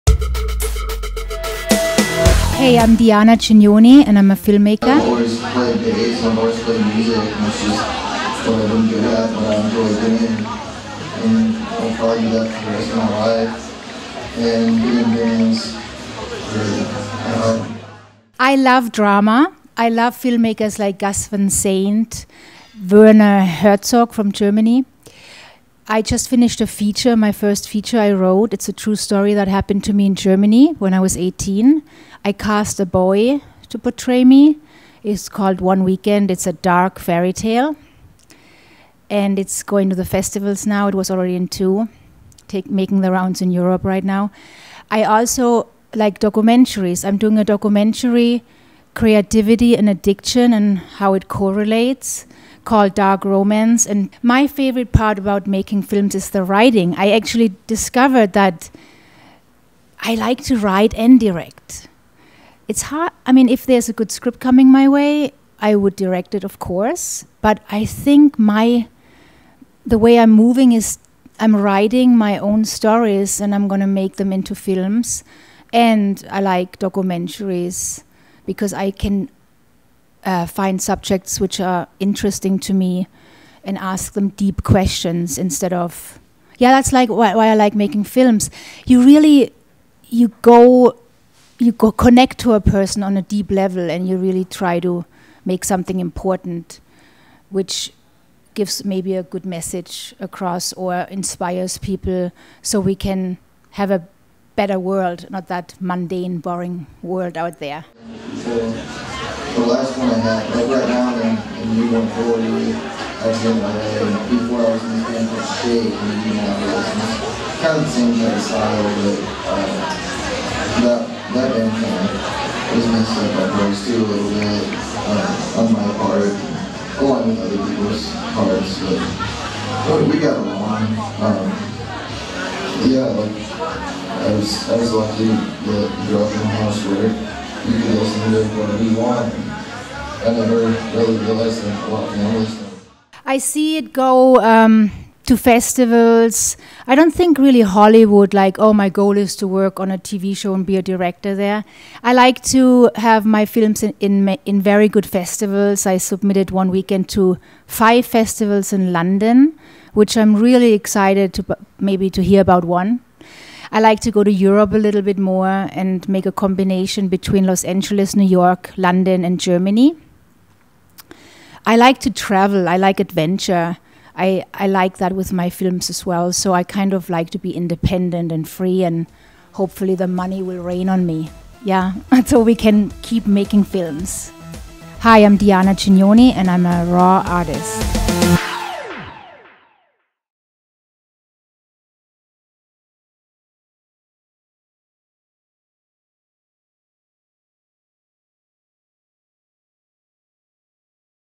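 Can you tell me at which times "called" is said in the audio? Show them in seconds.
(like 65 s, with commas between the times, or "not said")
35 s, 52 s.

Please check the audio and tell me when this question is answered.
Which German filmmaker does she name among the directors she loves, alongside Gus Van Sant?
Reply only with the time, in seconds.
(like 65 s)
22 s.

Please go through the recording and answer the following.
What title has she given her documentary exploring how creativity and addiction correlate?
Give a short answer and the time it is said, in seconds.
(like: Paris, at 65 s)
Dark Romance, at 52 s.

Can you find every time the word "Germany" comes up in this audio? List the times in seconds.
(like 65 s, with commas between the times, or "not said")
24 s, 30 s, 169 s.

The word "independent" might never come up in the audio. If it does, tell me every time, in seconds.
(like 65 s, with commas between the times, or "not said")
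177 s.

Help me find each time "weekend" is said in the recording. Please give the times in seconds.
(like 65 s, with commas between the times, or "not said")
35 s, 156 s.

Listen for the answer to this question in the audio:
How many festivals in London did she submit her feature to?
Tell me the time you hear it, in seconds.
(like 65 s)
157 s.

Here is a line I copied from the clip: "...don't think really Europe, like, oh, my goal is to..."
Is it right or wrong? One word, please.
wrong.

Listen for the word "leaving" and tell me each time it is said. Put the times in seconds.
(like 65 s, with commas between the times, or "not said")
not said.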